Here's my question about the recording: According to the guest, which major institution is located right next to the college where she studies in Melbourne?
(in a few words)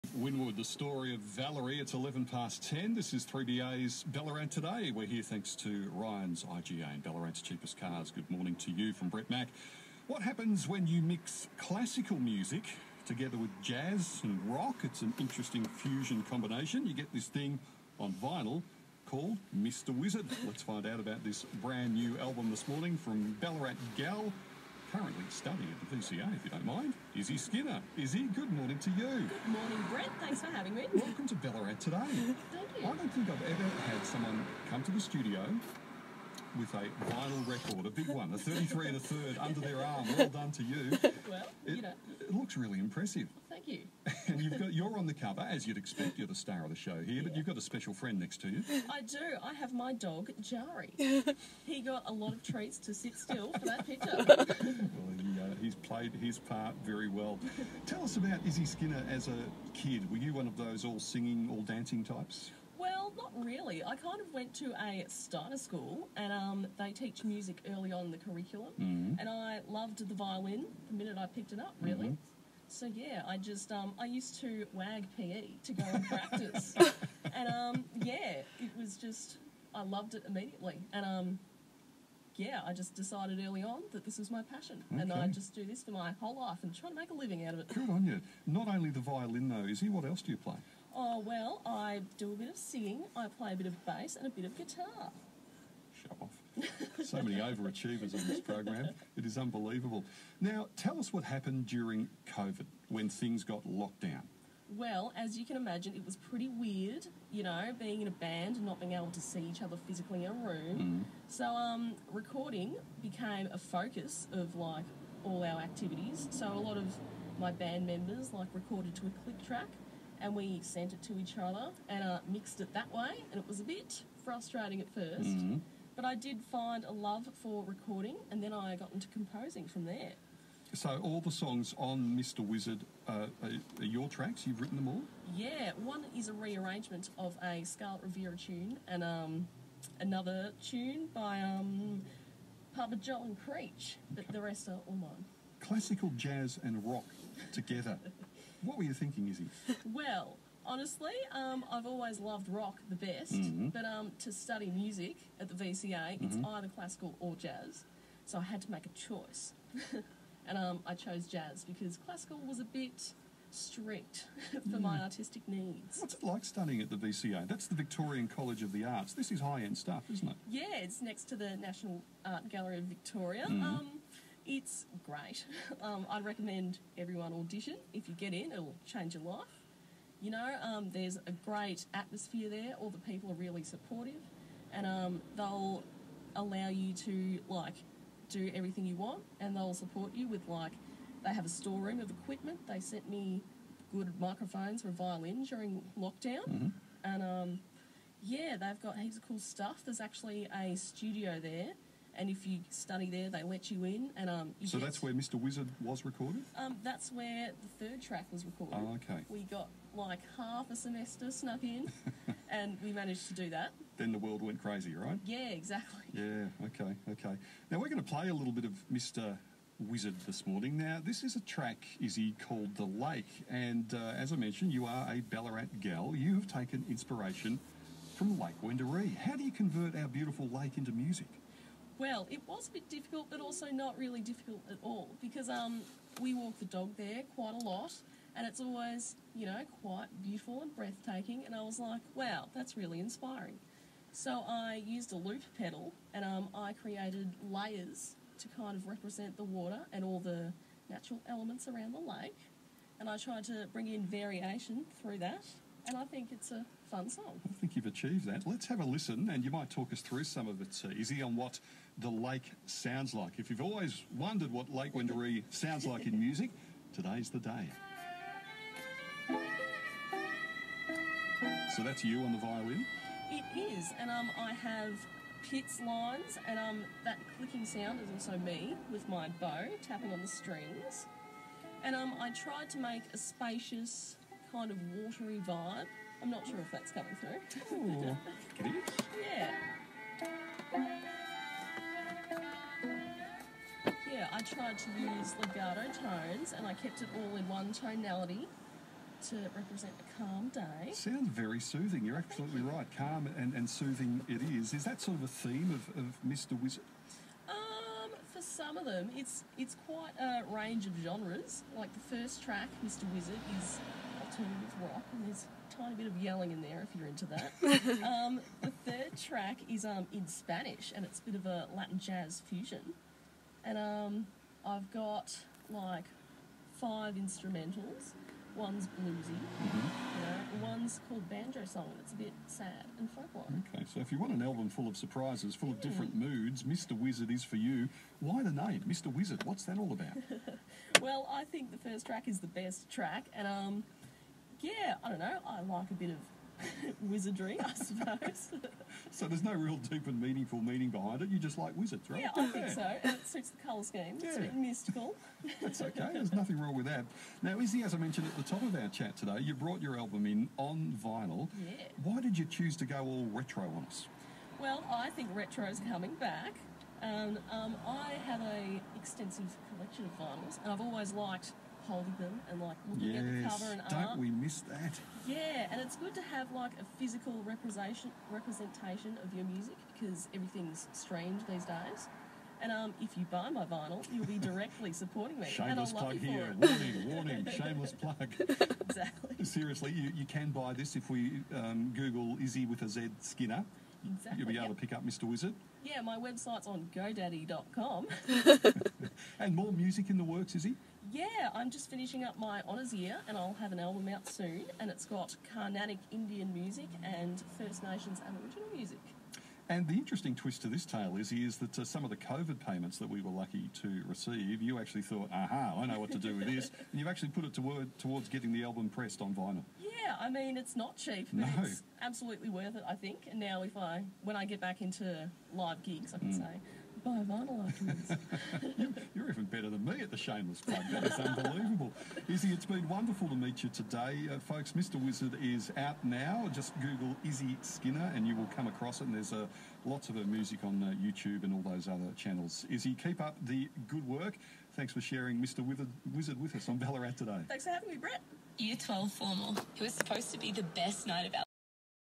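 National Art Gallery of Victoria.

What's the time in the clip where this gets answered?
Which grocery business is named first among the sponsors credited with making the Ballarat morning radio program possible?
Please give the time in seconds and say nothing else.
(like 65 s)
5 s.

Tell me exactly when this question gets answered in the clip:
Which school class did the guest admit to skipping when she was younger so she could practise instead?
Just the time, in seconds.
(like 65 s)
75 s.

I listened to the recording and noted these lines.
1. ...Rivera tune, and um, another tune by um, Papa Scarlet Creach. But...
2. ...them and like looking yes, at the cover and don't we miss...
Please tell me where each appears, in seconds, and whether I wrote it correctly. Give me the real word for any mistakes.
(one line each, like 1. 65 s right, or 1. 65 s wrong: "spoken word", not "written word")
1. 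138 s wrong: "John", not "Scarlet"
2. 372 s right.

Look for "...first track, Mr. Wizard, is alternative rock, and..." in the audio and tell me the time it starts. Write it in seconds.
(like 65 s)
312 s.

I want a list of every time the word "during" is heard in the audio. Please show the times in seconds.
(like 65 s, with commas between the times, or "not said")
101 s, 195 s.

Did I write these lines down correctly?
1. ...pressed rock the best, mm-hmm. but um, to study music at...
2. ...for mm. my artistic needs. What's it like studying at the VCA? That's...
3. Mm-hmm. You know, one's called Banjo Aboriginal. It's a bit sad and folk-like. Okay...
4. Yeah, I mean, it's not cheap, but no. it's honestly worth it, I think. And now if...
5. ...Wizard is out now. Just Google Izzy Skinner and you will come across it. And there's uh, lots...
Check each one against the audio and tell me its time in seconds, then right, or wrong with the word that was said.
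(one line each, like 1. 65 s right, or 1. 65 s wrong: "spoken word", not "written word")
1. 152 s wrong: "loved", not "pressed"
2. 164 s right
3. 329 s wrong: "Song", not "Aboriginal"
4. 419 s wrong: "absolutely", not "honestly"
5. 435 s right.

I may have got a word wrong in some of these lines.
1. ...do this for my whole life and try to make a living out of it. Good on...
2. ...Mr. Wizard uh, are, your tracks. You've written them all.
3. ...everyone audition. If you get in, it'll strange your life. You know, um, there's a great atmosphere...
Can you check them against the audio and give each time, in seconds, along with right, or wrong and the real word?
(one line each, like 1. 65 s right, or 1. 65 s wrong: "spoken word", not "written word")
1. 85 s right
2. 132 s right
3. 176 s wrong: "change", not "strange".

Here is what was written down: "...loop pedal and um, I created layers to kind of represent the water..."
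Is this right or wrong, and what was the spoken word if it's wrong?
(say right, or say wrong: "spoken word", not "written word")
right.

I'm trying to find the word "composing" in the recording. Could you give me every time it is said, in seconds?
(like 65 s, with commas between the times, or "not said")
129 s.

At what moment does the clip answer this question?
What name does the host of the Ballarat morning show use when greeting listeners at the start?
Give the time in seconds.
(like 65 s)
9 s.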